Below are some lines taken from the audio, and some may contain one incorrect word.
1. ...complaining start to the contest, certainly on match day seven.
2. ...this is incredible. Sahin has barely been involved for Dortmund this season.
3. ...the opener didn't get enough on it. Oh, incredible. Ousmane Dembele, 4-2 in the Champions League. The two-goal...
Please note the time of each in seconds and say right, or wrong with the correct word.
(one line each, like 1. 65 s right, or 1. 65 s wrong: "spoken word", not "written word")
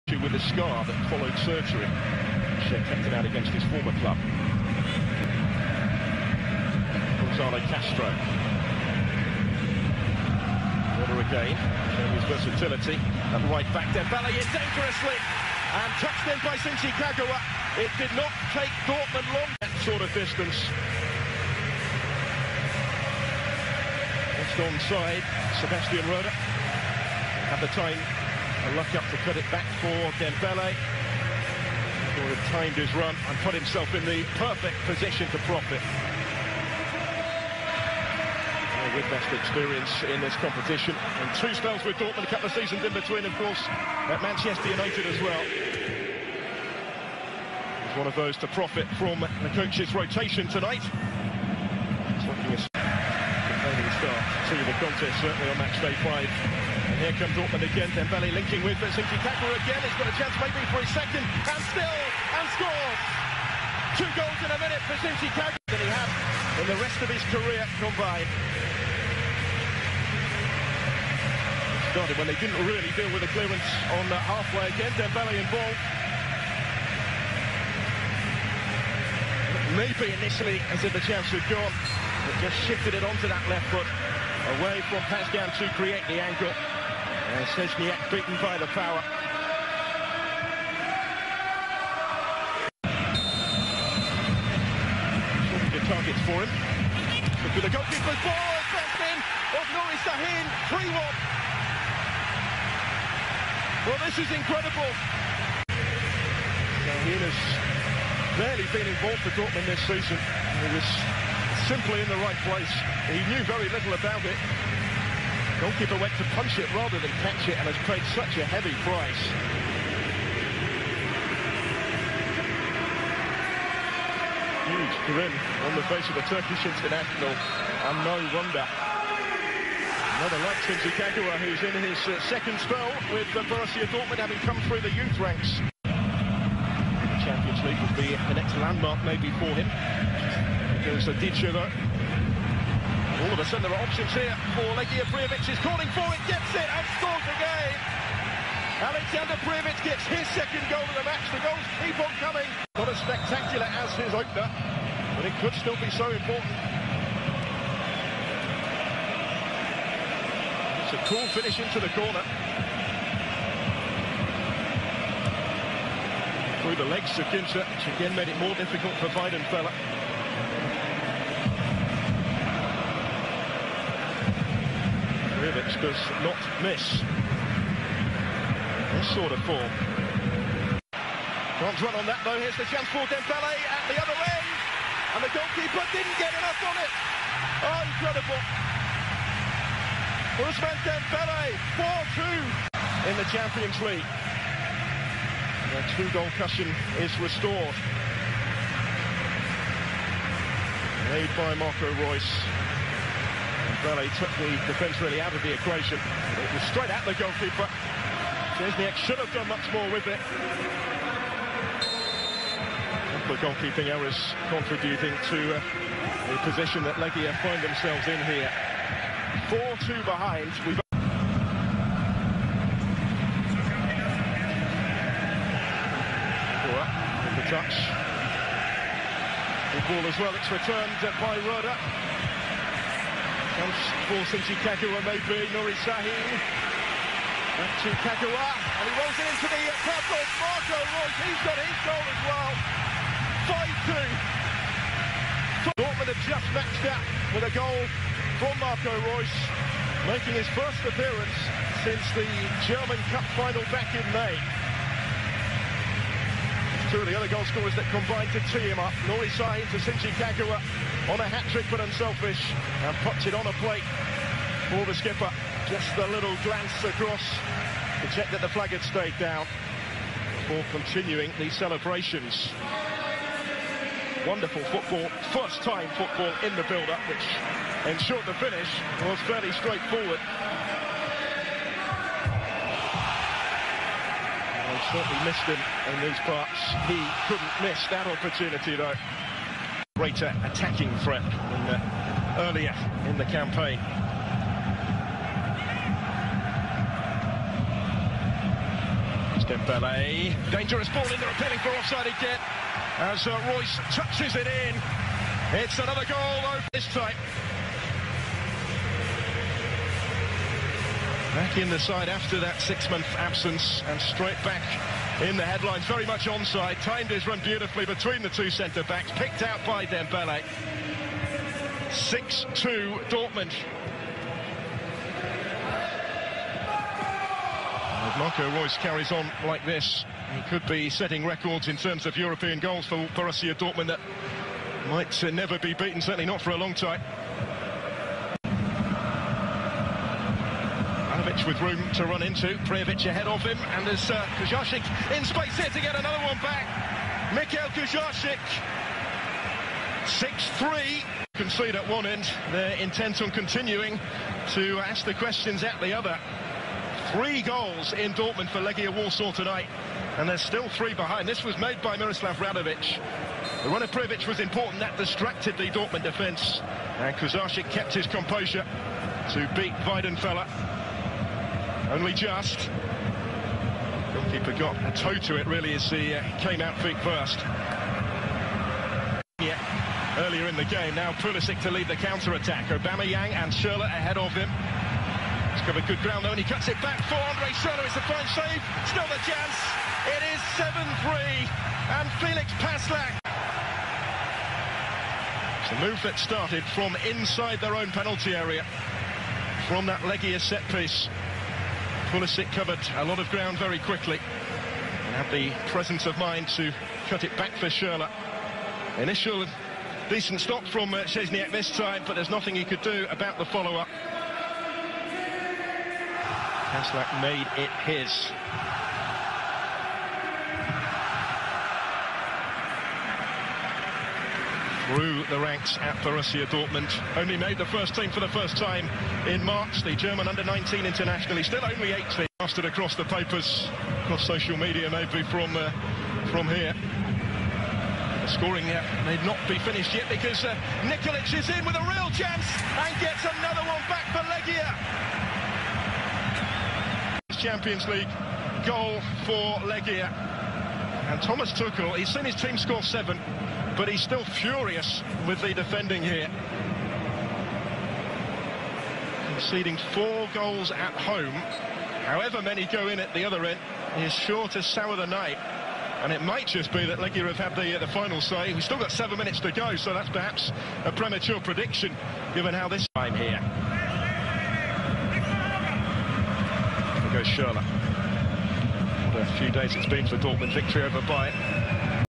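1. 53 s wrong: "five", not "seven"
2. 104 s right
3. 185 s wrong: "goalkeeper", not "opener".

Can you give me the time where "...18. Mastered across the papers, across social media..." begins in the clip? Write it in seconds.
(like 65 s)
431 s.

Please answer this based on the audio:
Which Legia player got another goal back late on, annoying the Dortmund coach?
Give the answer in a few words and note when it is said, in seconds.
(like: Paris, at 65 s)
Nikolic, at 440 s.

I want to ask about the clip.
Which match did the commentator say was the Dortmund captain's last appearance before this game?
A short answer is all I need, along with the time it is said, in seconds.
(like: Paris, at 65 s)
German Cup final, at 252 s.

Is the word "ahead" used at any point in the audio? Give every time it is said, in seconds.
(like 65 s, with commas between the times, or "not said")
343 s, 383 s.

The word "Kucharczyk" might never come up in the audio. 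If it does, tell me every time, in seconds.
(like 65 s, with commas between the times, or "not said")
341 s, 347 s, 367 s.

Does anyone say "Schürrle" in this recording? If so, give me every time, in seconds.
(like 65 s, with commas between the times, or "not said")
383 s, 387 s, 407 s.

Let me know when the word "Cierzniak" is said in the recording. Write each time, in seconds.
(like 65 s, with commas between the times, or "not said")
87 s, 208 s, 411 s.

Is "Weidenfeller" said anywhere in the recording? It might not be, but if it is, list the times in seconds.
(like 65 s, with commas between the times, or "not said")
169 s, 369 s.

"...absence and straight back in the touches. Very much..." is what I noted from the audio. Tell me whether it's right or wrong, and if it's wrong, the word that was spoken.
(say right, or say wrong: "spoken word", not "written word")
wrong: "headlines", not "touches".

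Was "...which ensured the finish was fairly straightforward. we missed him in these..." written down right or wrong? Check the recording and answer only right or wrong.
right.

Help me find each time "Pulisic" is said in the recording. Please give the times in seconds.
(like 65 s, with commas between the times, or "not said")
381 s, 402 s.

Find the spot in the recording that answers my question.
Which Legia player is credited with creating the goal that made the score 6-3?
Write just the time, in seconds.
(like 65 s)
361 s.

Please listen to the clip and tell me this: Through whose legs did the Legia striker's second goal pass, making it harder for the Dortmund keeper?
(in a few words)
Ginter.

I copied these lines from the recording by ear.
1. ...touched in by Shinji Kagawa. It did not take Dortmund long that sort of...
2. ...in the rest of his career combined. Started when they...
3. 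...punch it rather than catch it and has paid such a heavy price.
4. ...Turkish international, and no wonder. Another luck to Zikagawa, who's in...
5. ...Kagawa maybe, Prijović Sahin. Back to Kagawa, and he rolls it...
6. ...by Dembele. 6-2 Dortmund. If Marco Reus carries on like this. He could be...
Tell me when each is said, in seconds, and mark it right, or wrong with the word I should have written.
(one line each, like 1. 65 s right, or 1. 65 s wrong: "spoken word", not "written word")
1. 15 s right
2. 66 s right
3. 116 s right
4. 126 s right
5. 234 s wrong: "Nuri", not "Prijović"
6. 319 s right.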